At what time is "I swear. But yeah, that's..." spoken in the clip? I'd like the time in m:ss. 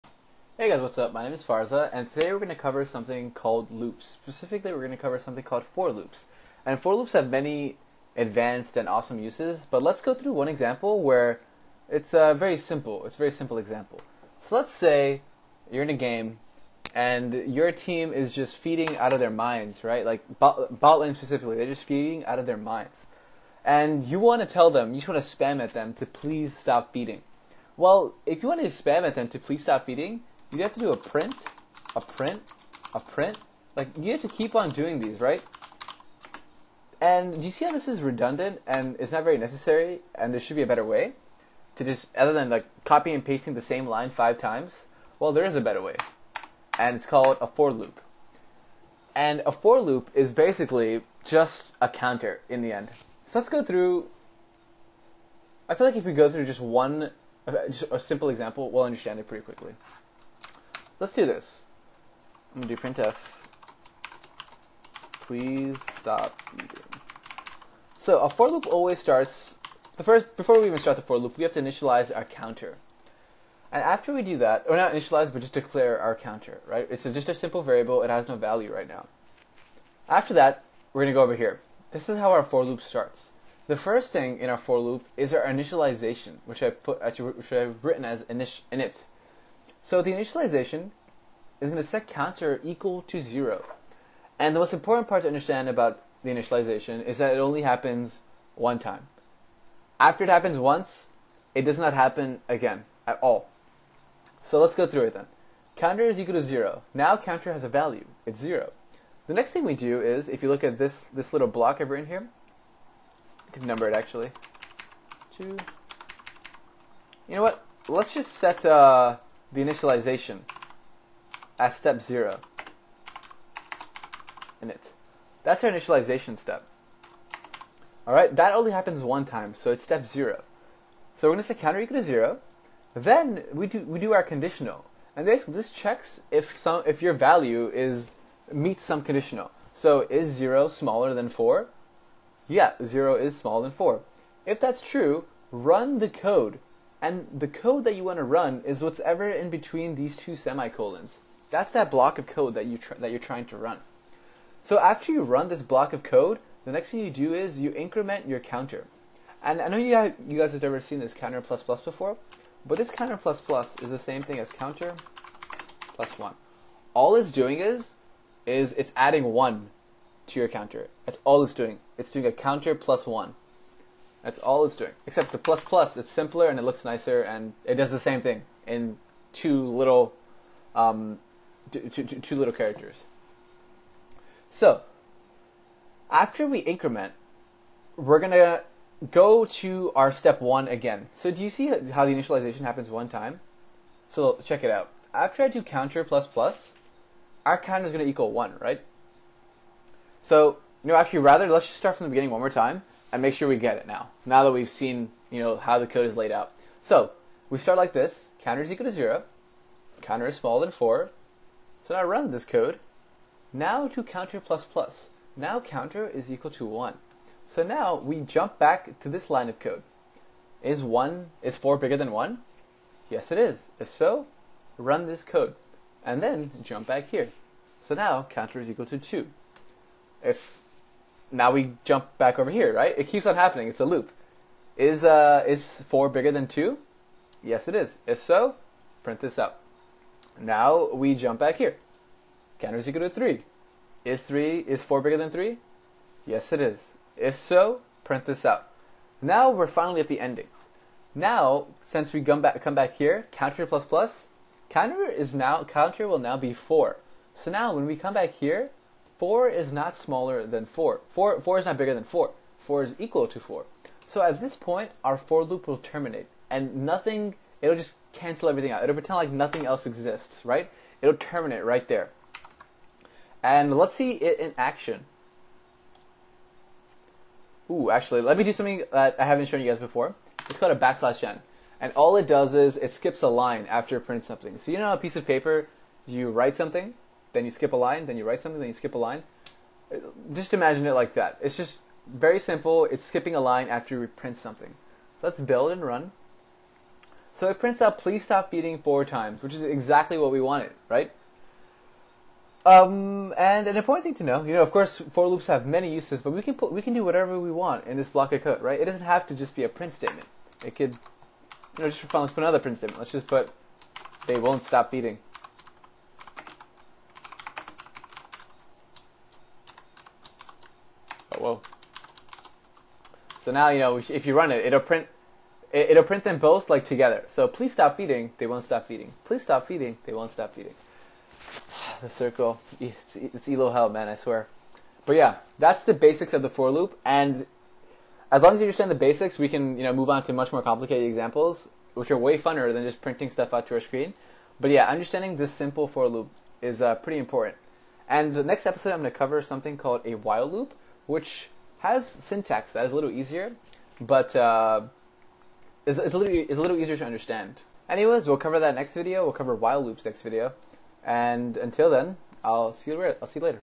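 5:34.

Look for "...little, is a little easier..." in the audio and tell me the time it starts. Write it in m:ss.
5:56.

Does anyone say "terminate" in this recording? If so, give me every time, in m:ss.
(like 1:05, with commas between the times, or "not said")
4:25, 4:31.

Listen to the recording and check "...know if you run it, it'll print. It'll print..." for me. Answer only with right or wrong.
right.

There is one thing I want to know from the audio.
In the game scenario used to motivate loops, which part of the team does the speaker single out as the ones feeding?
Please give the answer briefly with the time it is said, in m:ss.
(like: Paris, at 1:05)
bot lane, at 0:20.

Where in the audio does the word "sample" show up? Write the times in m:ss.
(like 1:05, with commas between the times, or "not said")
not said.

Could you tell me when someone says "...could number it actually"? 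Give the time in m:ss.
1:53.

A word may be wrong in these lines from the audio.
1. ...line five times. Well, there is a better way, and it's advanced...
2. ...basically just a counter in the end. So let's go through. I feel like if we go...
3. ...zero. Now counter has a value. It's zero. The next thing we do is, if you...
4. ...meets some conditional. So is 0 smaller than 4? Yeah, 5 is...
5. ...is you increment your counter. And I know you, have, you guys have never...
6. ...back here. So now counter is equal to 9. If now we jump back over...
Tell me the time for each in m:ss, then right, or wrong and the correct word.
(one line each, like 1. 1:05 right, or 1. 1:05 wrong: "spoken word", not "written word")
1. 0:43 wrong: "called", not "advanced"
2. 0:50 right
3. 1:46 right
4. 2:18 wrong: "0", not "5"
5. 2:37 right
6. 3:46 wrong: "2", not "9".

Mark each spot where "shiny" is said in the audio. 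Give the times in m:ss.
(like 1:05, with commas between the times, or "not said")
not said.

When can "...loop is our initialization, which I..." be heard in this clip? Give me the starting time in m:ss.
1:24.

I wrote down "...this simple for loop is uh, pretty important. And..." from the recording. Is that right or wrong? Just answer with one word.
right.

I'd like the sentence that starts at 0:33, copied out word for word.
Like you have to keep on doing these, right?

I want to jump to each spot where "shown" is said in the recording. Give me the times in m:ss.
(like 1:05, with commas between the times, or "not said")
4:39.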